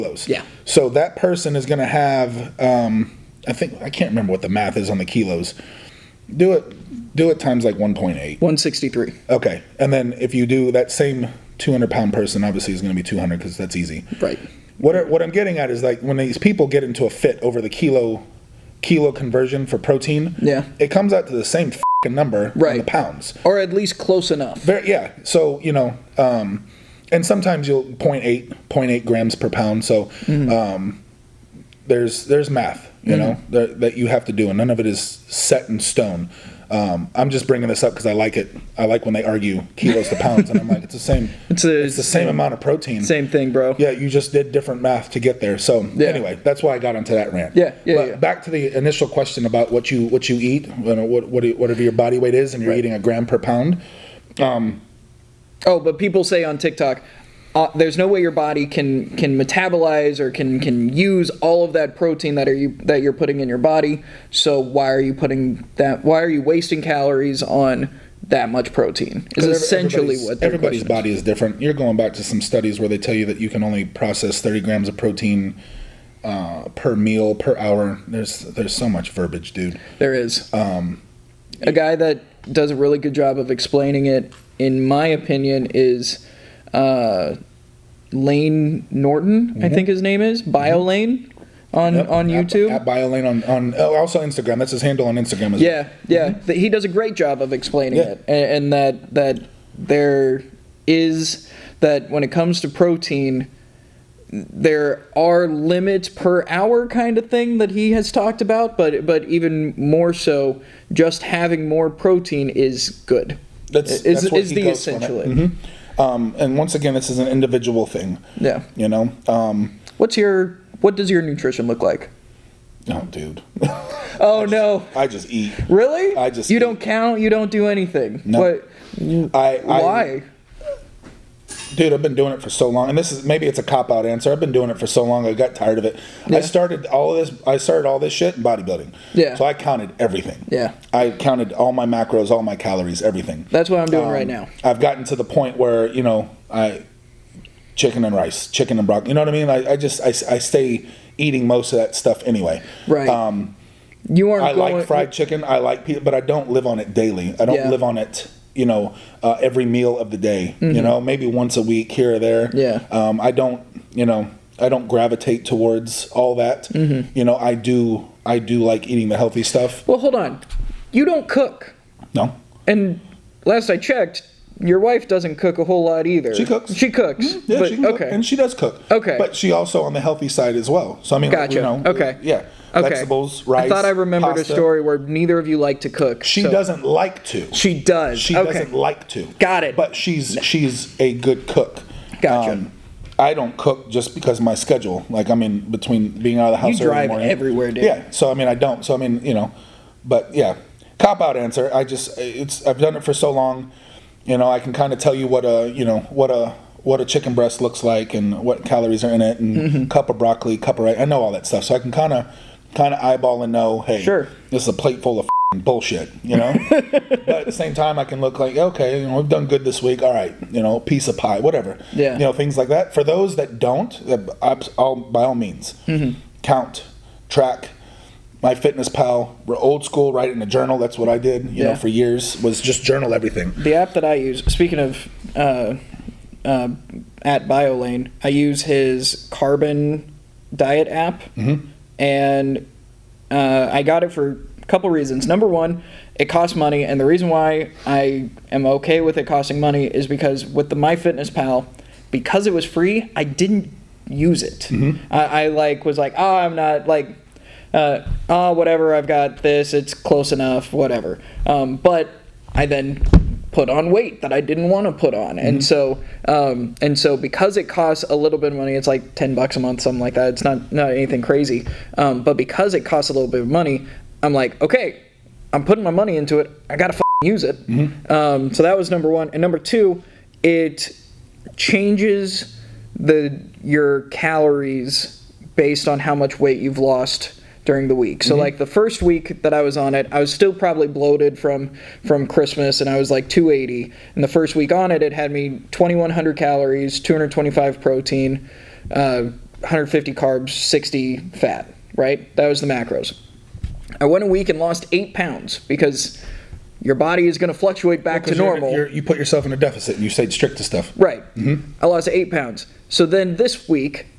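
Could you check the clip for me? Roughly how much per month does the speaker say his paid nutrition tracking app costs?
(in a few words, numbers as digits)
$10.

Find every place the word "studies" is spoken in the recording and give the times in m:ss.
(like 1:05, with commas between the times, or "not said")
1:12.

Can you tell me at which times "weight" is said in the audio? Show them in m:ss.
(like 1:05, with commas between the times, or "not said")
0:52, 4:23, 4:46.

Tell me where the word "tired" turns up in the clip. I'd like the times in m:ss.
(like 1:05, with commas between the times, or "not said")
2:15.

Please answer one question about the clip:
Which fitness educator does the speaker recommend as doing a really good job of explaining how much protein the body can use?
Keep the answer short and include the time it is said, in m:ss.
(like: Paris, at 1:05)
Layne Norton, at 1:28.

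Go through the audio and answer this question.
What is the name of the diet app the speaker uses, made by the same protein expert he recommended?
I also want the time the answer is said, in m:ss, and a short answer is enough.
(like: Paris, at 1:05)
Carbon, at 3:59.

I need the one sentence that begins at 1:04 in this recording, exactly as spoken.
So why are you putting that?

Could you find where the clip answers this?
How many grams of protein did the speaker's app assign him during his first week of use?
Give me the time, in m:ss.
4:56.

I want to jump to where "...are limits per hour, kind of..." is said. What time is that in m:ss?
1:45.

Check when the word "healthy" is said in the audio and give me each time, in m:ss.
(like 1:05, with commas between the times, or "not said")
2:49, 3:00.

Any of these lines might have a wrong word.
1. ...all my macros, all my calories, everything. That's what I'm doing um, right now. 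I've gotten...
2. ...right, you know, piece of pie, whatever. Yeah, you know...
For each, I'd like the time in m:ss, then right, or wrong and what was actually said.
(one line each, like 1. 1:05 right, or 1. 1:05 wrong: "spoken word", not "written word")
1. 2:21 right
2. 3:40 right.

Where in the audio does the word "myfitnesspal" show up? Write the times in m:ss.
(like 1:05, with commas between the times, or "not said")
3:48, 4:10.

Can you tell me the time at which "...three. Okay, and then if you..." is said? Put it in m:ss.
0:08.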